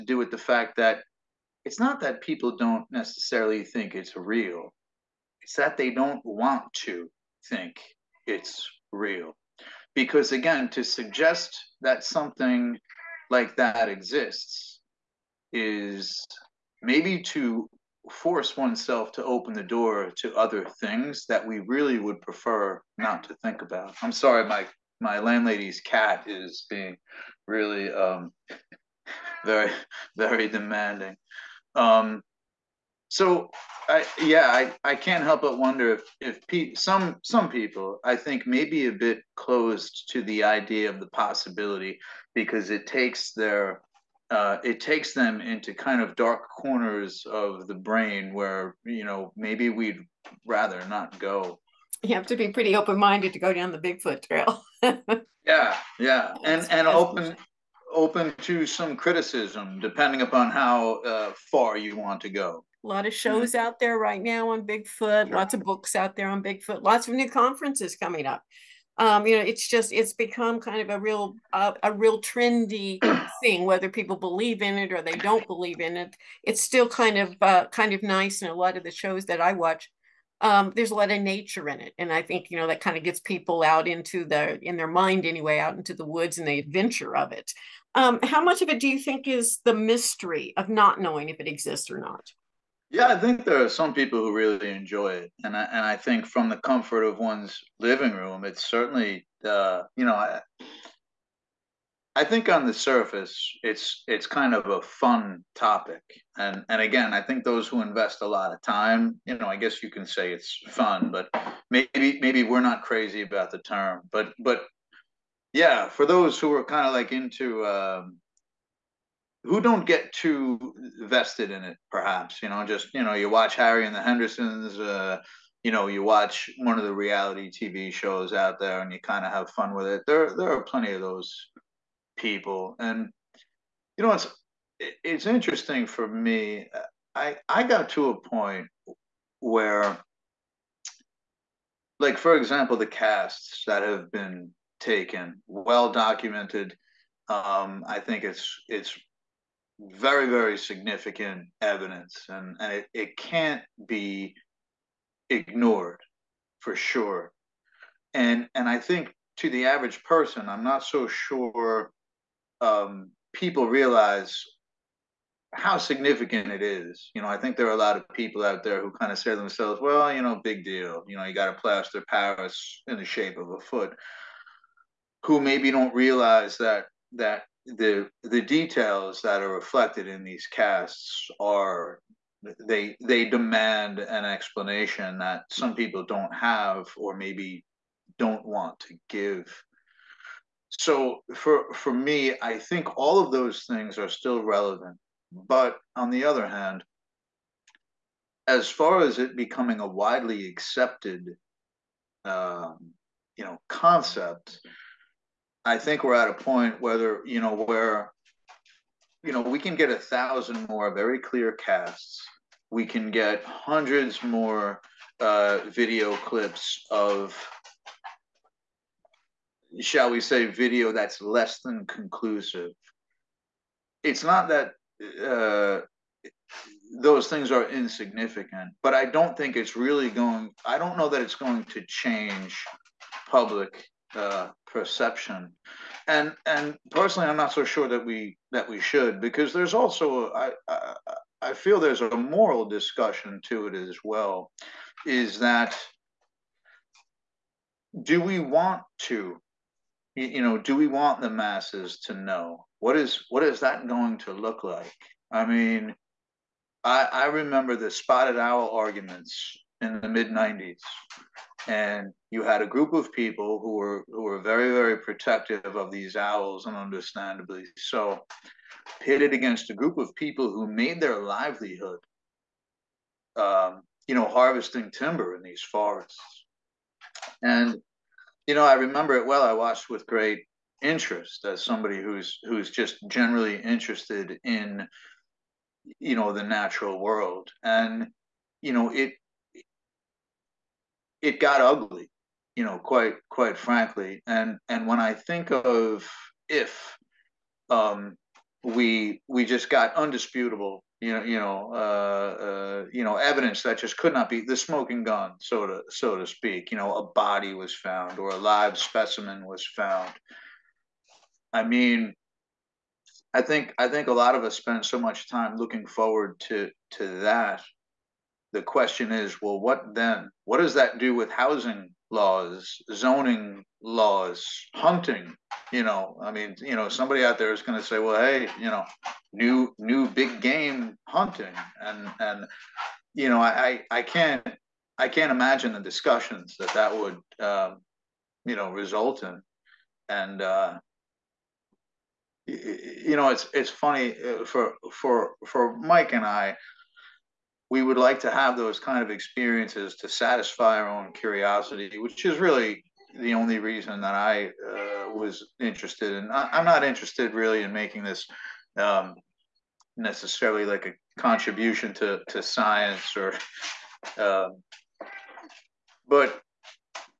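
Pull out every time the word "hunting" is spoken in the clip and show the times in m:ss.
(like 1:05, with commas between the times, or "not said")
5:24, 5:31.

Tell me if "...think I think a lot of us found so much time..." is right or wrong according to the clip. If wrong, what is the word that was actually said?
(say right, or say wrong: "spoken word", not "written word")
wrong: "spend", not "found".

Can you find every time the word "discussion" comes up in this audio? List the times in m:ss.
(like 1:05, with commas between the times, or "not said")
4:02, 5:35.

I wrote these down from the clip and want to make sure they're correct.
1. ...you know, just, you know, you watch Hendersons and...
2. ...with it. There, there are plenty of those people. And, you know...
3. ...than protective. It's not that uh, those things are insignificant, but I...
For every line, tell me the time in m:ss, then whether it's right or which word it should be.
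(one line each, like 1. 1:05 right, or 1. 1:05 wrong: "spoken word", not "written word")
1. 2:02 wrong: "Harry", not "Hendersons"
2. 2:09 right
3. 3:41 wrong: "conclusive", not "protective".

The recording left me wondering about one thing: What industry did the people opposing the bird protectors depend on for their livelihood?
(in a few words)
harvesting timber.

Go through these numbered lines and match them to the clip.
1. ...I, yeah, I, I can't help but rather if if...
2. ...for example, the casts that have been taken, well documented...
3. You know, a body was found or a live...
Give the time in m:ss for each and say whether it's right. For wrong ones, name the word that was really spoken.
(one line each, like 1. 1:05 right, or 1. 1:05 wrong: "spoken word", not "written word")
1. 0:33 wrong: "wonder", not "rather"
2. 2:22 right
3. 5:06 right.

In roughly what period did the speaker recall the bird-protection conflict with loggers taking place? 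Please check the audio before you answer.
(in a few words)
mid 90s.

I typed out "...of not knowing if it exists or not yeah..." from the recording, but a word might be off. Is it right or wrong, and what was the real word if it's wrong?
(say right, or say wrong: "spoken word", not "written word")
right.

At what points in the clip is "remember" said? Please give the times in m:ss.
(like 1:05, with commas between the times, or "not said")
4:17, 4:38.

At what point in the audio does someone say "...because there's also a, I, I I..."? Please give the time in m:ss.
3:59.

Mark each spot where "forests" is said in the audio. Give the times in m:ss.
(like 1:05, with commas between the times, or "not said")
4:35.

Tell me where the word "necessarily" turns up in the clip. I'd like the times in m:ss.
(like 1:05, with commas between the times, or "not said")
0:02, 5:59.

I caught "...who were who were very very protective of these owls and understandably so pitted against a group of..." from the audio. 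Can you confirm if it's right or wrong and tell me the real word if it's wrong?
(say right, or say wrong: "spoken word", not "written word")
right.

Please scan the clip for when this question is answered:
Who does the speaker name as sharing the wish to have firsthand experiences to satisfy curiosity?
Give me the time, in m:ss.
5:45.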